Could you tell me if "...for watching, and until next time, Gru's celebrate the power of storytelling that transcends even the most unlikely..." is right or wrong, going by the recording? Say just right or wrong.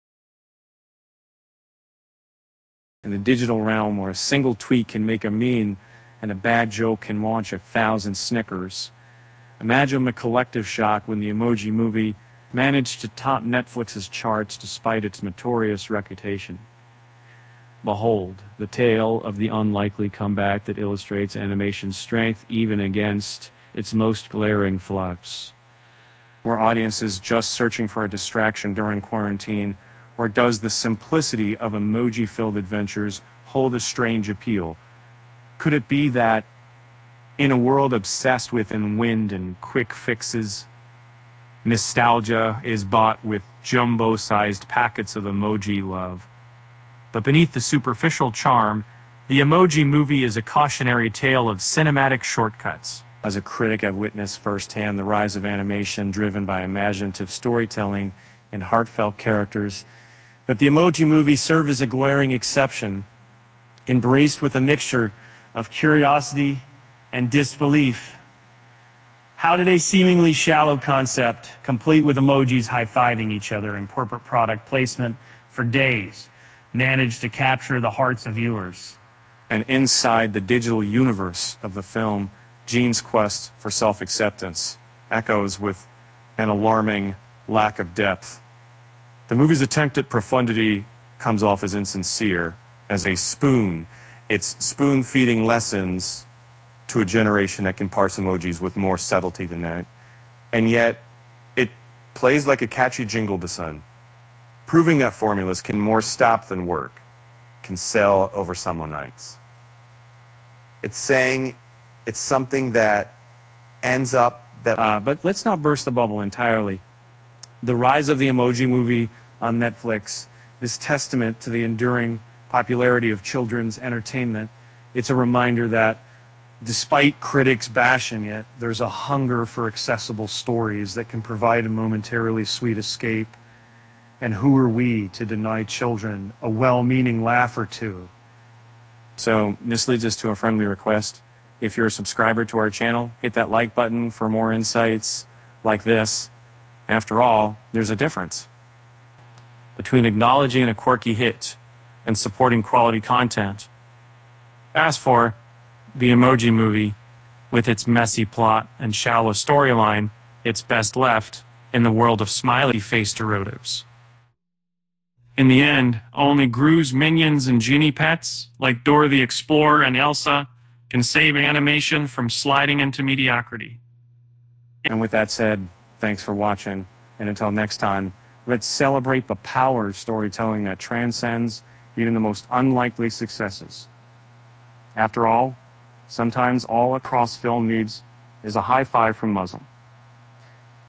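wrong.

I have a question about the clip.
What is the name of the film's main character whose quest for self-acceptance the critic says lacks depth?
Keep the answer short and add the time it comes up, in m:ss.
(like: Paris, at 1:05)
Gene, at 1:22.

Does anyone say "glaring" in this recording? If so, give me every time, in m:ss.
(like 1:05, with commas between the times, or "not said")
0:24, 1:01.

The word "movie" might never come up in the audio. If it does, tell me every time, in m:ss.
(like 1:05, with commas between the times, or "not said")
0:11, 0:49, 1:01, 1:29, 1:58, 2:36.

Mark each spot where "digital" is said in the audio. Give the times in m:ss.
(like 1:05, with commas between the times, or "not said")
0:03, 1:20.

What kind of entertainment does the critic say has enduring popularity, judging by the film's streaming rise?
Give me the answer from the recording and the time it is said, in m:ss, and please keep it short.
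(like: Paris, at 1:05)
Children's entertainment, at 2:03.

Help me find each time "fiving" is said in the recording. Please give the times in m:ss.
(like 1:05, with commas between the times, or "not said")
1:12.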